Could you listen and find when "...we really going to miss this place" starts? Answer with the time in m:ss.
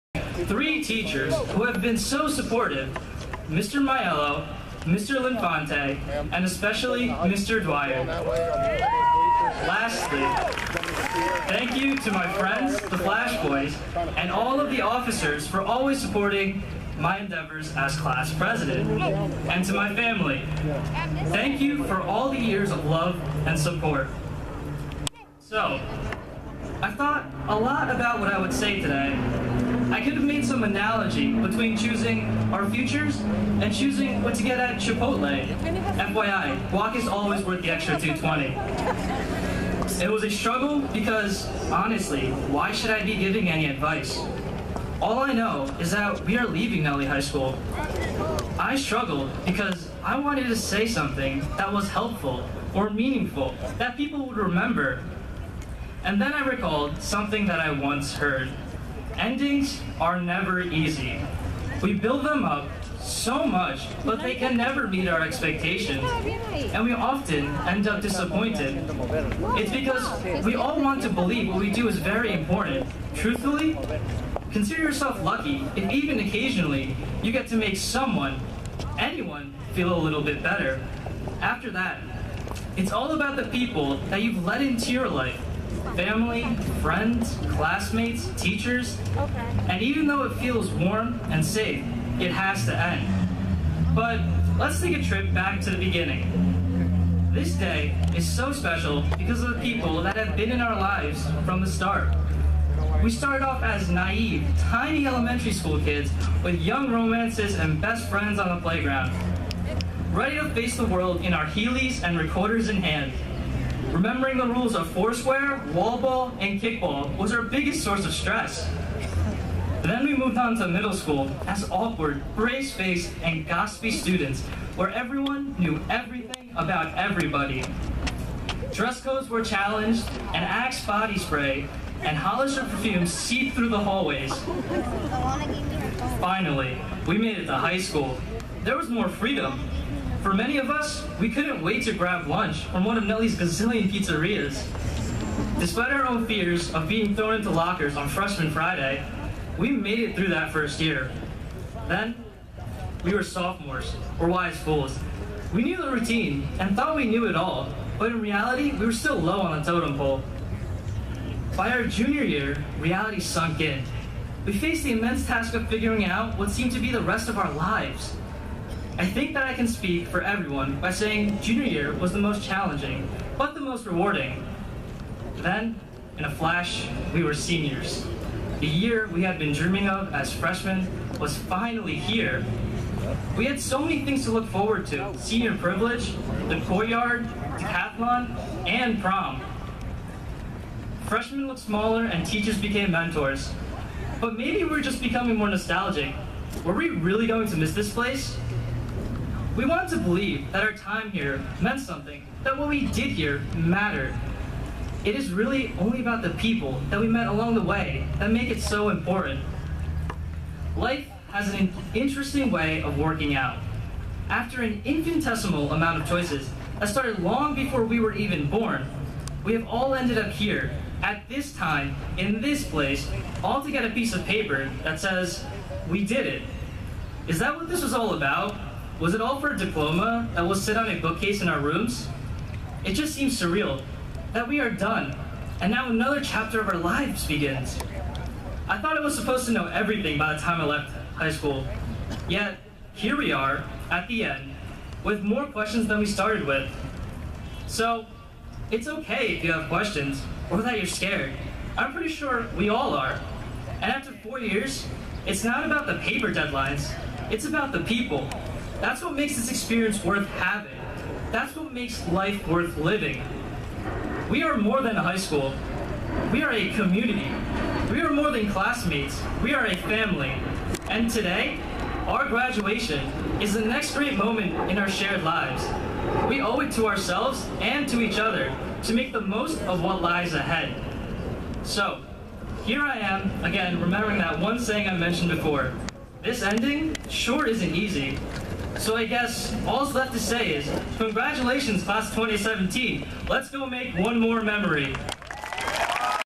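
3:16.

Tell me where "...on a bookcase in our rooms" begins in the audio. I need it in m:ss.
3:50.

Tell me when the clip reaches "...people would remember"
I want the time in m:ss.
0:53.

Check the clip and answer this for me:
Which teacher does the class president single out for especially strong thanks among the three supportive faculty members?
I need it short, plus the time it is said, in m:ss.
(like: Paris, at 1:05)
Mr. Dwyer, at 0:07.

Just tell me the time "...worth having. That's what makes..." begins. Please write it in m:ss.
4:20.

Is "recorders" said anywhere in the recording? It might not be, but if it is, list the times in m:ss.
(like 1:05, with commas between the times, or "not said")
1:52.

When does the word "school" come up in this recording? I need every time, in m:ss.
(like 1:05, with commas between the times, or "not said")
0:47, 1:45, 2:00, 2:17, 4:01, 4:25.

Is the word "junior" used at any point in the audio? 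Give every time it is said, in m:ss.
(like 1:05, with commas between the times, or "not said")
2:41, 2:51.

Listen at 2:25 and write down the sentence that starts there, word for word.
Despite our own fears of being thrown into lockers on Freshman Friday, we made it through that first year.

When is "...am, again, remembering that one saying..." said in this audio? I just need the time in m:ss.
4:42.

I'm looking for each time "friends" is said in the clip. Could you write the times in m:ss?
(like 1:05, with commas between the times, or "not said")
0:12, 1:26, 1:48.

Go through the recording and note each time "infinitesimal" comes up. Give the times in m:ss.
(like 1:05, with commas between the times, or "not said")
3:34.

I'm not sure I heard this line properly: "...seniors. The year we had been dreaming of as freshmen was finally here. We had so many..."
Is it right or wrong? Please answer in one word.
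right.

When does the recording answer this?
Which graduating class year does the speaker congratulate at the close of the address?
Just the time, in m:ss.
4:52.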